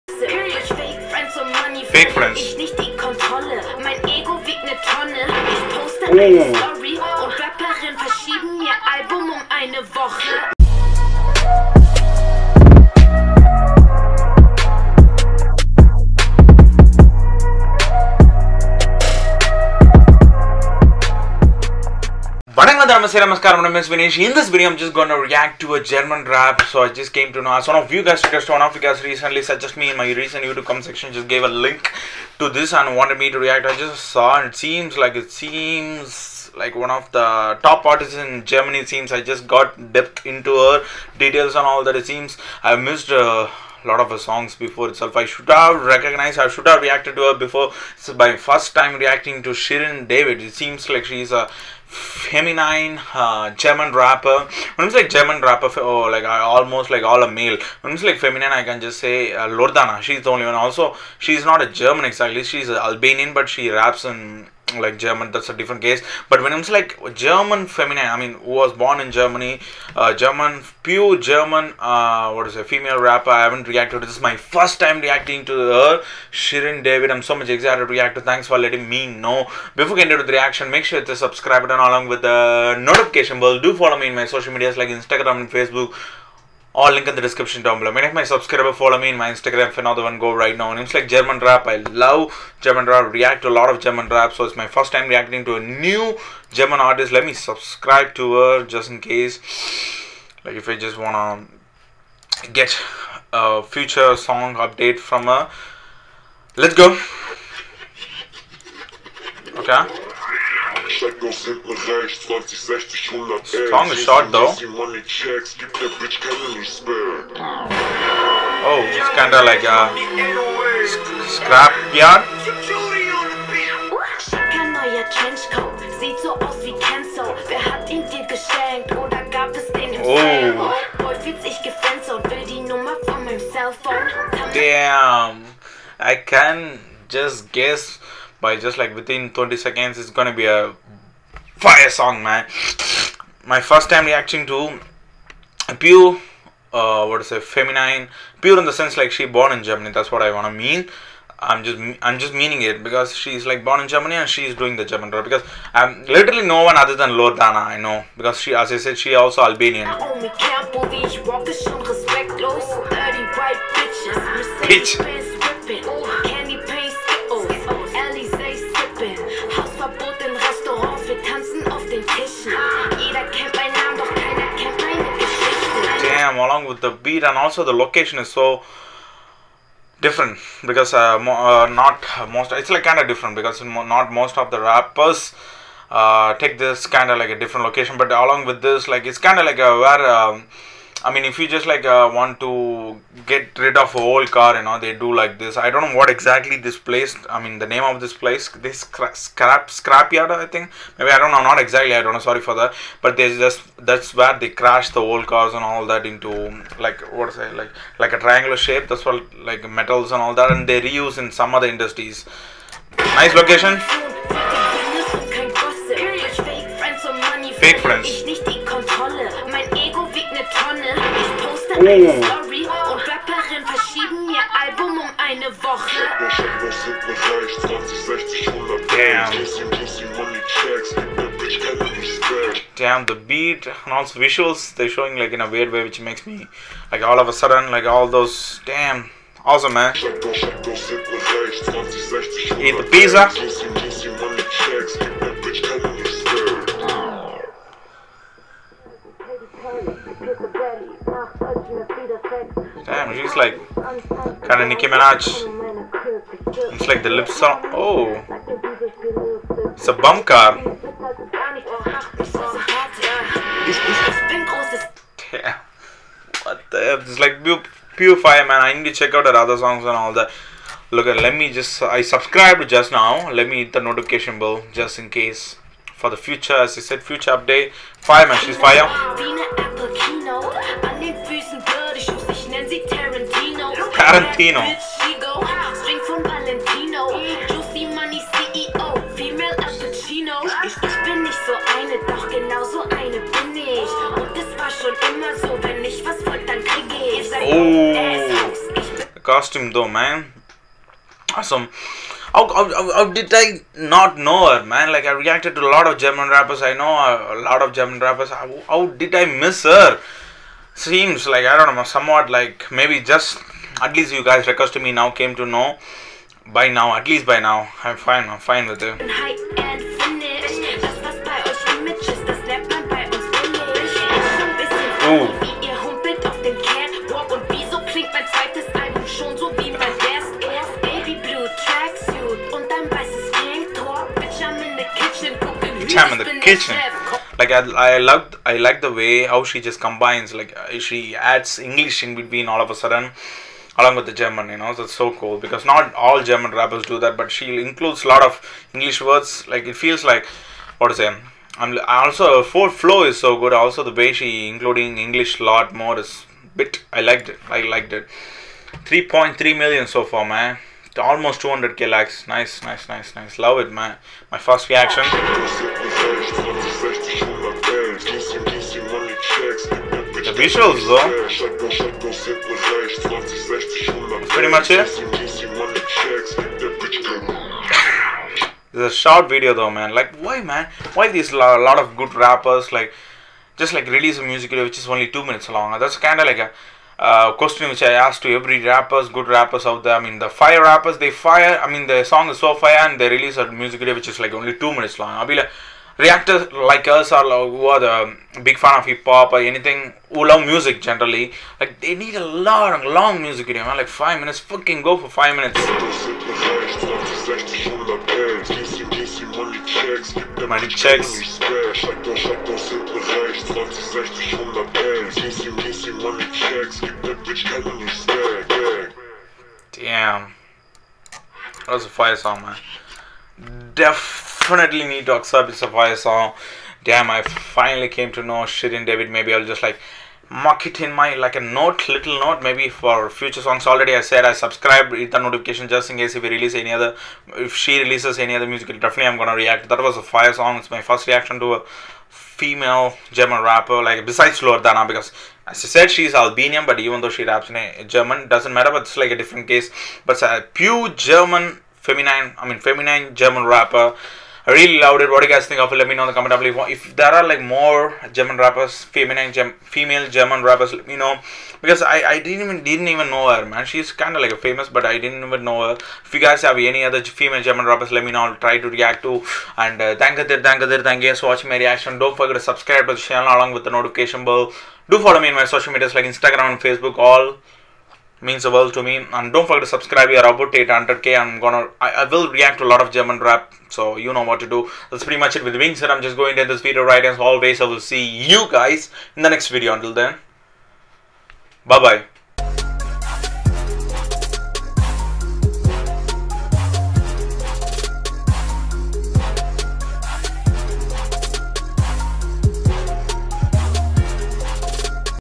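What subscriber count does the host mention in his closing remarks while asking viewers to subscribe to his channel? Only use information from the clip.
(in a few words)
800k.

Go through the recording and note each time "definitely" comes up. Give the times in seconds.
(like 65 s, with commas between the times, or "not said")
424 s, 438 s.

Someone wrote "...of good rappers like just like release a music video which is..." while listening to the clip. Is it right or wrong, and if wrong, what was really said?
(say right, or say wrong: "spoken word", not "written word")
right.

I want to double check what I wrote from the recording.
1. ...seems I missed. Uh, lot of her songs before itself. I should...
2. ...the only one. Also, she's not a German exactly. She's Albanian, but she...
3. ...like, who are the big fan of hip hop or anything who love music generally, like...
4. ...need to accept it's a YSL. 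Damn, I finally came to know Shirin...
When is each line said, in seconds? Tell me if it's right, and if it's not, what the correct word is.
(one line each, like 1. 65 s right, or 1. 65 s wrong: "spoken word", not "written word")
1. 42 s right
2. 60 s right
3. 397 s right
4. 424 s right.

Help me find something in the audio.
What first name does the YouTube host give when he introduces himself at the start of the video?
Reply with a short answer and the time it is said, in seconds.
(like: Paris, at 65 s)
Vinesh, at 23 s.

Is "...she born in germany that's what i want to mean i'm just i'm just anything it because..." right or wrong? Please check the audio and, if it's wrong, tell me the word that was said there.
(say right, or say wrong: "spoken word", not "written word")
wrong: "meaning", not "anything".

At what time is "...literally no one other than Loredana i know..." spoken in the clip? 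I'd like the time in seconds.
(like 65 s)
156 s.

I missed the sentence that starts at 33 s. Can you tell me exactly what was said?
I just saw and it seems like it seems like one of the top artists in Germany.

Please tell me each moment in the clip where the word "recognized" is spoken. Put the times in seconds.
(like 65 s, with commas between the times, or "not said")
45 s.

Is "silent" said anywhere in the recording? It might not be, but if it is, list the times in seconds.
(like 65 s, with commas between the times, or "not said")
not said.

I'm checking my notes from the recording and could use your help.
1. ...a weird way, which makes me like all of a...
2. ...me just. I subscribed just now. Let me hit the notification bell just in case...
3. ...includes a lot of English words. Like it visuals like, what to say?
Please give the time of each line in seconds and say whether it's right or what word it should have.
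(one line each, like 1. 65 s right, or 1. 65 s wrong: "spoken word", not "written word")
1. 235 s right
2. 271 s right
3. 347 s wrong: "feels", not "visuals".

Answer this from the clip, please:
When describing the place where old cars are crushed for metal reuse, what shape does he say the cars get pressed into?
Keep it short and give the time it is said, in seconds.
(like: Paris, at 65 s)
Triangular, at 208 s.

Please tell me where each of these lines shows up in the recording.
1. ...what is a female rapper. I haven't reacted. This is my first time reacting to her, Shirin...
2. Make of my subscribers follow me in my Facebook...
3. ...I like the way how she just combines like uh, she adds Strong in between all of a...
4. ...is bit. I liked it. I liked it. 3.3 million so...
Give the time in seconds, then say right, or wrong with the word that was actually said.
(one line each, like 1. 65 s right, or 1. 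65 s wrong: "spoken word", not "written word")
1. 72 s right
2. 87 s wrong: "Instagram", not "Facebook"
3. 338 s wrong: "English", not "Strong"
4. 355 s right.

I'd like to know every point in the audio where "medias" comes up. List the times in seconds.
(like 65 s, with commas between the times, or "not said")
84 s, 475 s.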